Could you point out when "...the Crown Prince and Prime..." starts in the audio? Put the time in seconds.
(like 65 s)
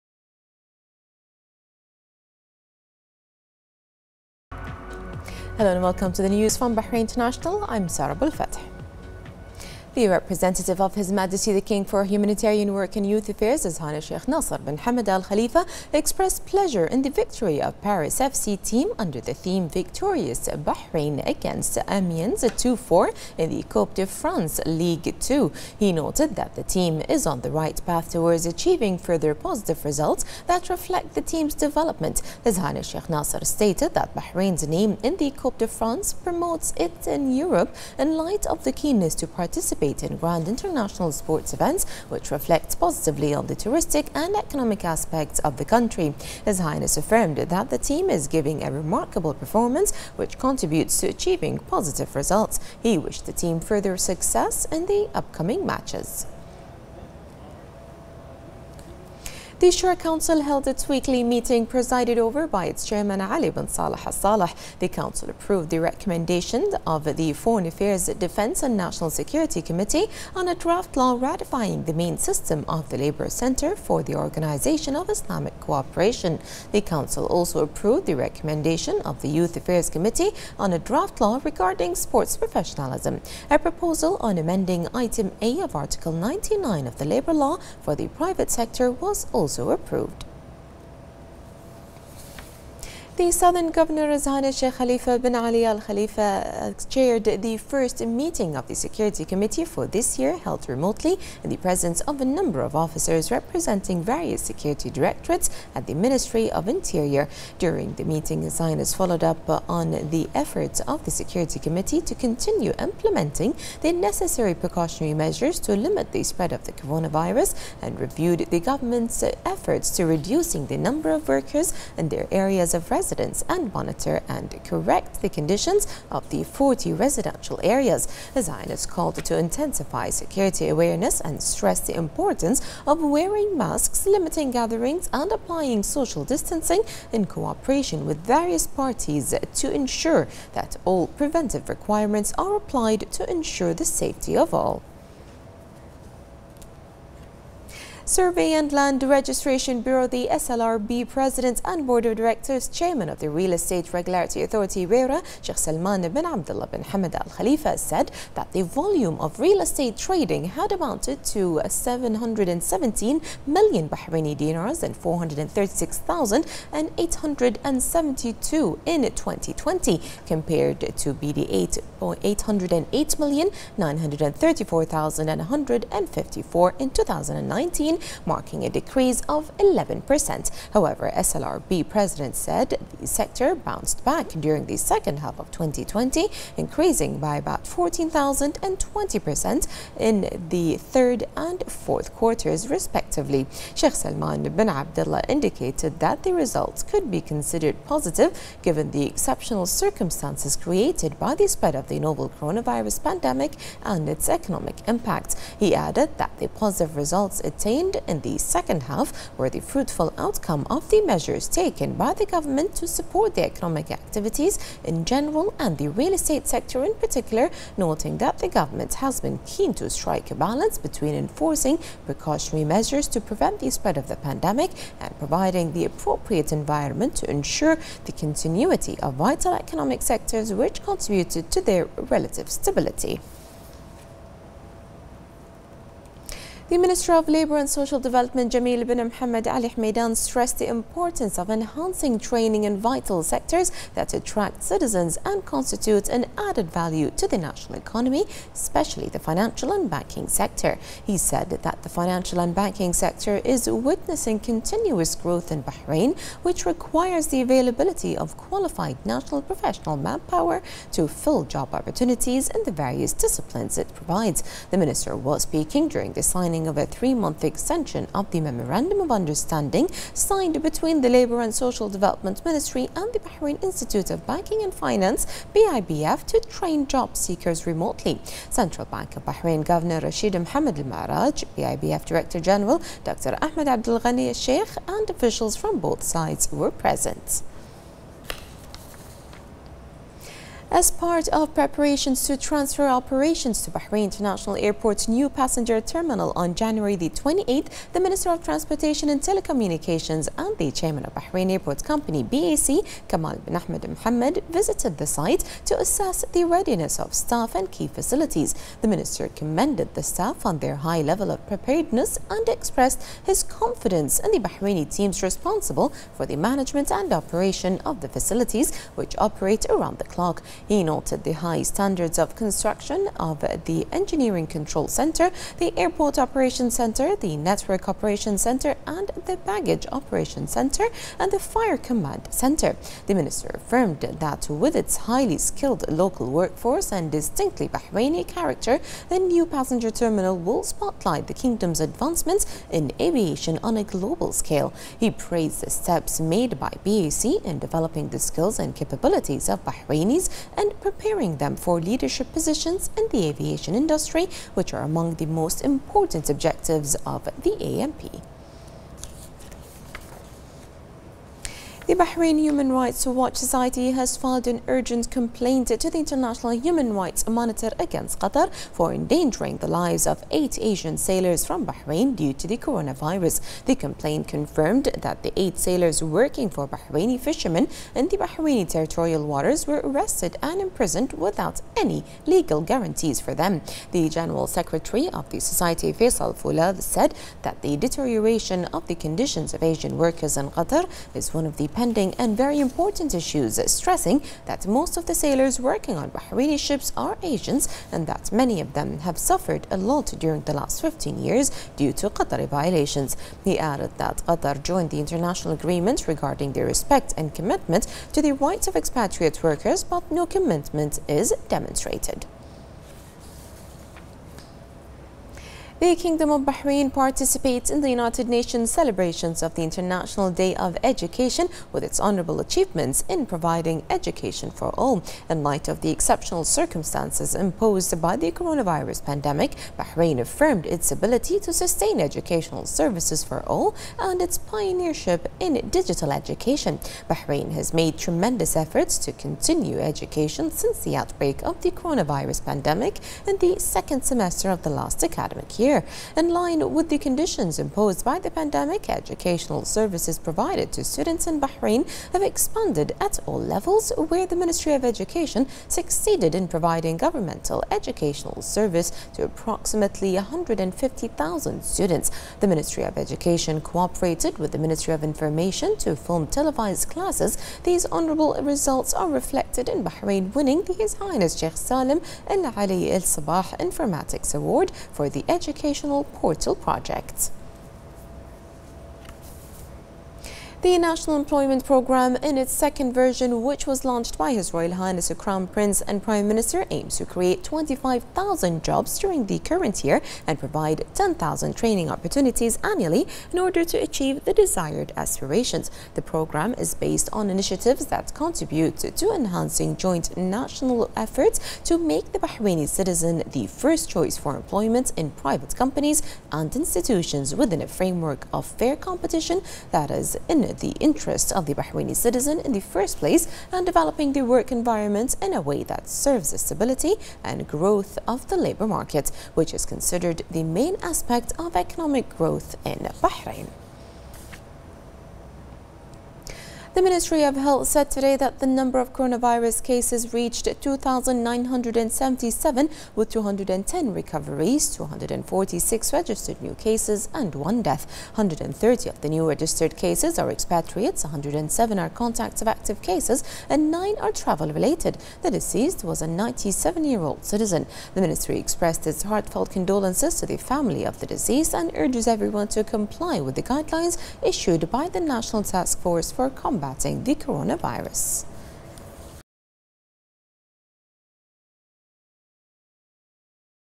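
485 s.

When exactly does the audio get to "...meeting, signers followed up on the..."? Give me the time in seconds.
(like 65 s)
108 s.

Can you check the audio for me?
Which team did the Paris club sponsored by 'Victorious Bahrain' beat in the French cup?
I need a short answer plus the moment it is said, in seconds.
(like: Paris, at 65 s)
Amiens, at 21 s.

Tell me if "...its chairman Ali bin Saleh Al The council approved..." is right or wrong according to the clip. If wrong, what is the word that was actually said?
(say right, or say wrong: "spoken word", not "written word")
right.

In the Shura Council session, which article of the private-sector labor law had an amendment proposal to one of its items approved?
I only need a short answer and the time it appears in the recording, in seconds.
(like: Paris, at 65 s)
Article 99, at 85 s.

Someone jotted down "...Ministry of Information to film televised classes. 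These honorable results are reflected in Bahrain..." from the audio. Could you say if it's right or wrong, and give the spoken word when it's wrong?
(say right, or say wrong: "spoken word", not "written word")
right.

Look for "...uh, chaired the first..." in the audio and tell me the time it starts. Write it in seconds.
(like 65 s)
96 s.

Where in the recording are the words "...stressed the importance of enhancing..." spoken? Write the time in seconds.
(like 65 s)
240 s.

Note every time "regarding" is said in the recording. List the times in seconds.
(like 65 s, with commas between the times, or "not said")
81 s, 406 s.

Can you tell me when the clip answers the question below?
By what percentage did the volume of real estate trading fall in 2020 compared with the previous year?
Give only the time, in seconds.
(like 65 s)
179 s.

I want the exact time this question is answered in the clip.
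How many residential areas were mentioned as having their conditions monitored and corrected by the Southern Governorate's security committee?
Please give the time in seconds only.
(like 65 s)
126 s.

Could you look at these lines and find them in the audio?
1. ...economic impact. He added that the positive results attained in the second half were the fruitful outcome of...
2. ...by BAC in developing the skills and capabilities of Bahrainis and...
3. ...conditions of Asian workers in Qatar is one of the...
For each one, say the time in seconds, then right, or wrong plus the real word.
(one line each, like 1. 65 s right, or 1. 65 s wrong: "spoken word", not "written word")
1. 204 s right
2. 346 s right
3. 388 s right.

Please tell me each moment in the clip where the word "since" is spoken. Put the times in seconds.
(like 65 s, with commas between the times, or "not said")
440 s.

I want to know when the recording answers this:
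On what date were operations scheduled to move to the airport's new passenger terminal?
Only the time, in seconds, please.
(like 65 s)
296 s.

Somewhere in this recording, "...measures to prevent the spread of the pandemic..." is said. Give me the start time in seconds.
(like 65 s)
222 s.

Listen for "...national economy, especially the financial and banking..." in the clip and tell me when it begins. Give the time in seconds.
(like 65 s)
247 s.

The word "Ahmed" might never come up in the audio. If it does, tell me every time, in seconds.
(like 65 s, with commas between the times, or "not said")
283 s, 303 s.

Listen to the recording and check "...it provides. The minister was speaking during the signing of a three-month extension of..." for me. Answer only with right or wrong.
right.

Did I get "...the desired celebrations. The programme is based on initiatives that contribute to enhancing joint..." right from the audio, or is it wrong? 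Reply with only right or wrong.
wrong.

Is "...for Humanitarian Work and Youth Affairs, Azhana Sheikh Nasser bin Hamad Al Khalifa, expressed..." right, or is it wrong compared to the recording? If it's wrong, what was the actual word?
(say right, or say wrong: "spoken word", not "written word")
right.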